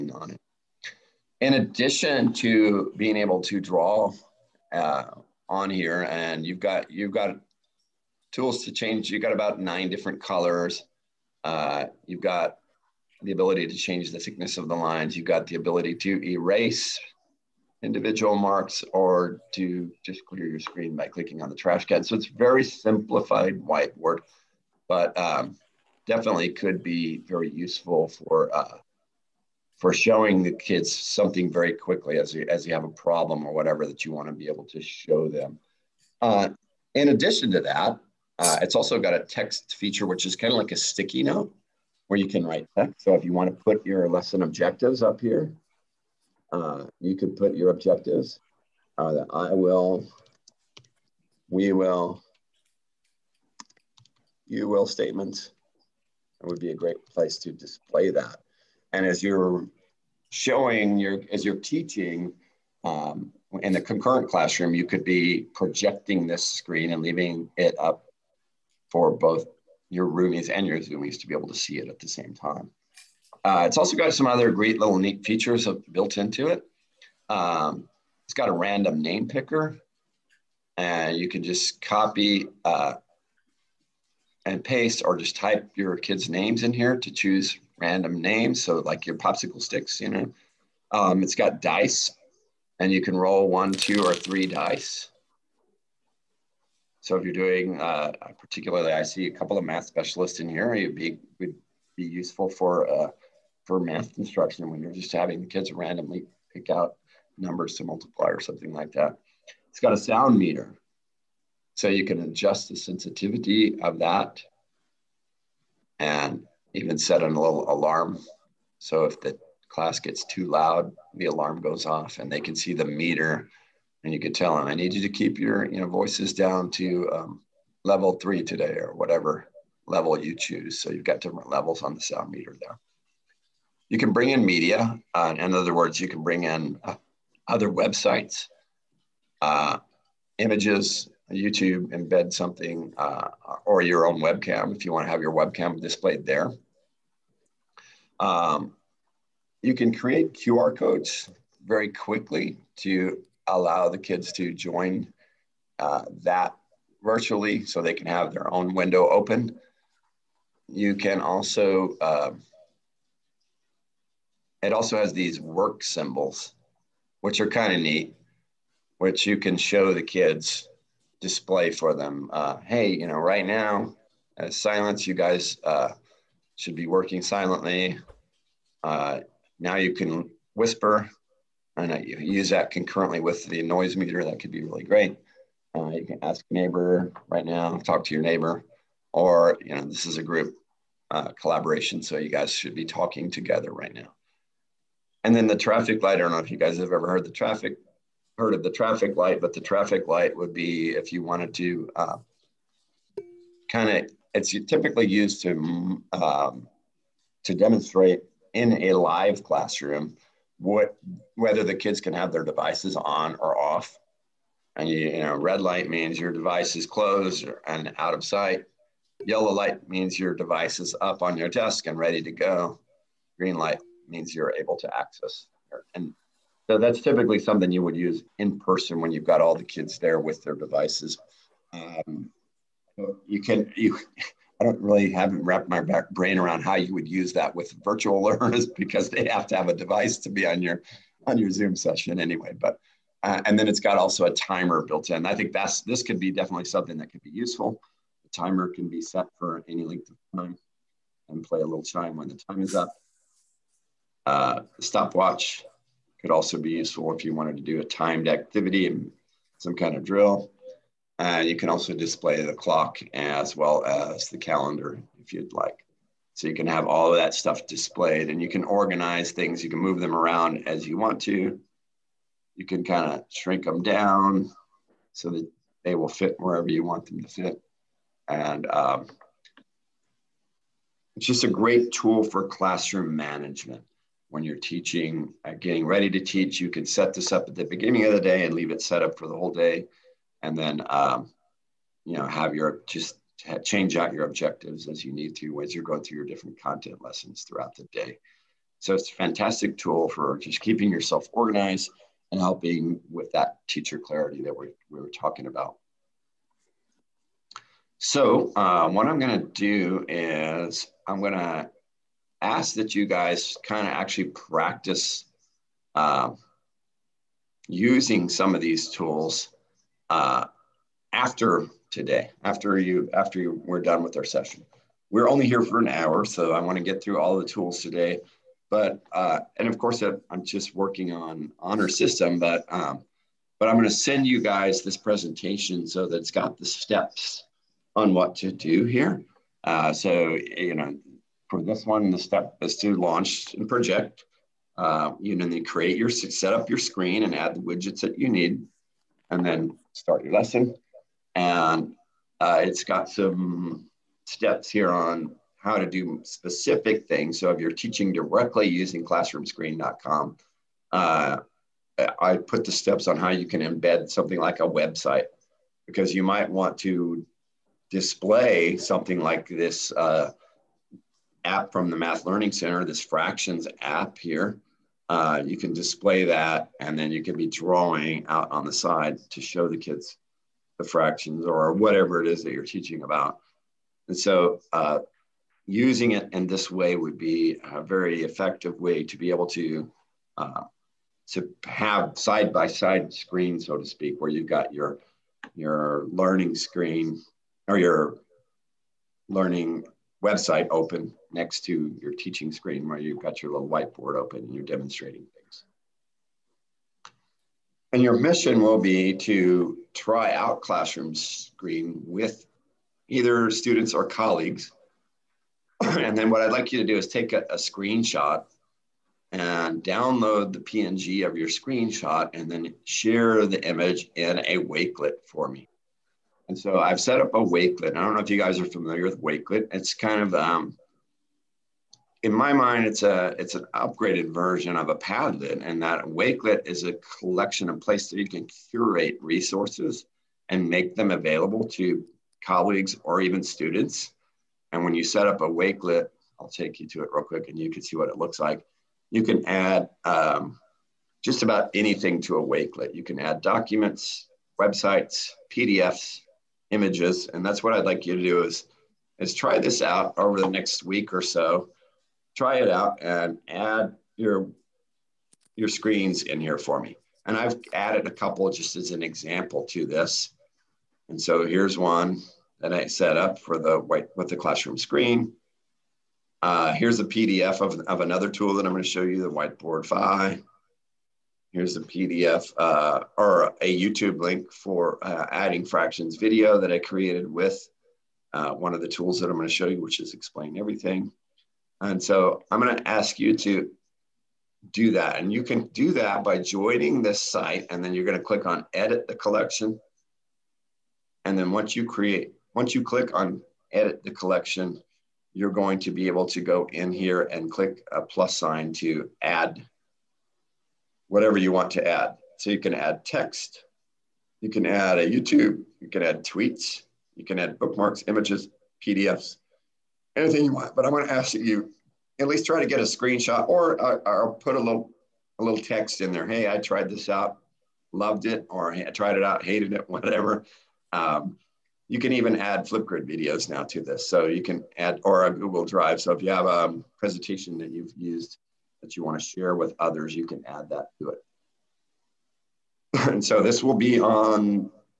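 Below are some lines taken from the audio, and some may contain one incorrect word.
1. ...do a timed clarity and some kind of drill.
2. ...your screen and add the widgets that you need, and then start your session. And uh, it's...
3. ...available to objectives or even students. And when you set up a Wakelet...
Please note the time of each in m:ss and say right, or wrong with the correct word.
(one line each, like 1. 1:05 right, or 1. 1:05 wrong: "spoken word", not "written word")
1. 4:17 wrong: "activity", not "clarity"
2. 5:46 wrong: "lesson", not "session"
3. 7:21 wrong: "colleagues", not "objectives".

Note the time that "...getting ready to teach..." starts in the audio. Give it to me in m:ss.
4:45.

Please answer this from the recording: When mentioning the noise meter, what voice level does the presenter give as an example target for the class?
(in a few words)
level 3.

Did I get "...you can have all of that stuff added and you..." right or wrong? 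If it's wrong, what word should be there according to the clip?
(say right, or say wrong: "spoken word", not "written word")
wrong: "displayed", not "added".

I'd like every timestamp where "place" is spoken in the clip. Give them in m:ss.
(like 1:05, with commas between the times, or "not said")
0:57, 7:17.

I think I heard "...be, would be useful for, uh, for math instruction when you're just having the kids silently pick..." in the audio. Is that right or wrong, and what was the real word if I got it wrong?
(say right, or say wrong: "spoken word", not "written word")
wrong: "randomly", not "silently".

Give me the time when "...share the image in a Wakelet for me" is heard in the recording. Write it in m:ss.
7:02.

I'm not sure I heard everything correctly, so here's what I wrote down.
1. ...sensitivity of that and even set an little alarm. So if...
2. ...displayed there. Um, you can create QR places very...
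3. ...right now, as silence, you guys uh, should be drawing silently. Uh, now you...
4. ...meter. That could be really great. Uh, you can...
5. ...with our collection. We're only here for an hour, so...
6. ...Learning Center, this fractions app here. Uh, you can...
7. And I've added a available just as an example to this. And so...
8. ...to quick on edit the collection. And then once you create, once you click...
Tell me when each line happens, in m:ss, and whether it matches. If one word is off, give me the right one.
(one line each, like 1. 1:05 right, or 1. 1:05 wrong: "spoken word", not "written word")
1. 1:52 right
2. 2:25 wrong: "codes", not "places"
3. 2:53 wrong: "working", not "drawing"
4. 3:03 right
5. 5:24 wrong: "session", not "collection"
6. 6:12 right
7. 7:47 wrong: "couple", not "available"
8. 8:18 wrong: "click", not "quick".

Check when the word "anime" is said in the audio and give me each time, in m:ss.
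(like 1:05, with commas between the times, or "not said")
not said.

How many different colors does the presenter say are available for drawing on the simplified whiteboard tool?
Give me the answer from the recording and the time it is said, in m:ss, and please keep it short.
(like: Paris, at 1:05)
9, at 0:09.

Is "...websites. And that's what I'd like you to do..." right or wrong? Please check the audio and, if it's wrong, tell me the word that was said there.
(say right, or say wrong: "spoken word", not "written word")
wrong: "images", not "websites".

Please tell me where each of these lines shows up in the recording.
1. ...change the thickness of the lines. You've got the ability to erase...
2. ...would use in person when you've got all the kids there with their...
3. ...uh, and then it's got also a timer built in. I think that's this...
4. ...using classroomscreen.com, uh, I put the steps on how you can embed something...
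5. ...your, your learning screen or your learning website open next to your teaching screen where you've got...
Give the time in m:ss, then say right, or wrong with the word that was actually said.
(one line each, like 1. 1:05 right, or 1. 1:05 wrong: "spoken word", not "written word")
1. 0:13 right
2. 3:47 right
3. 4:03 right
4. 5:58 right
5. 6:34 right.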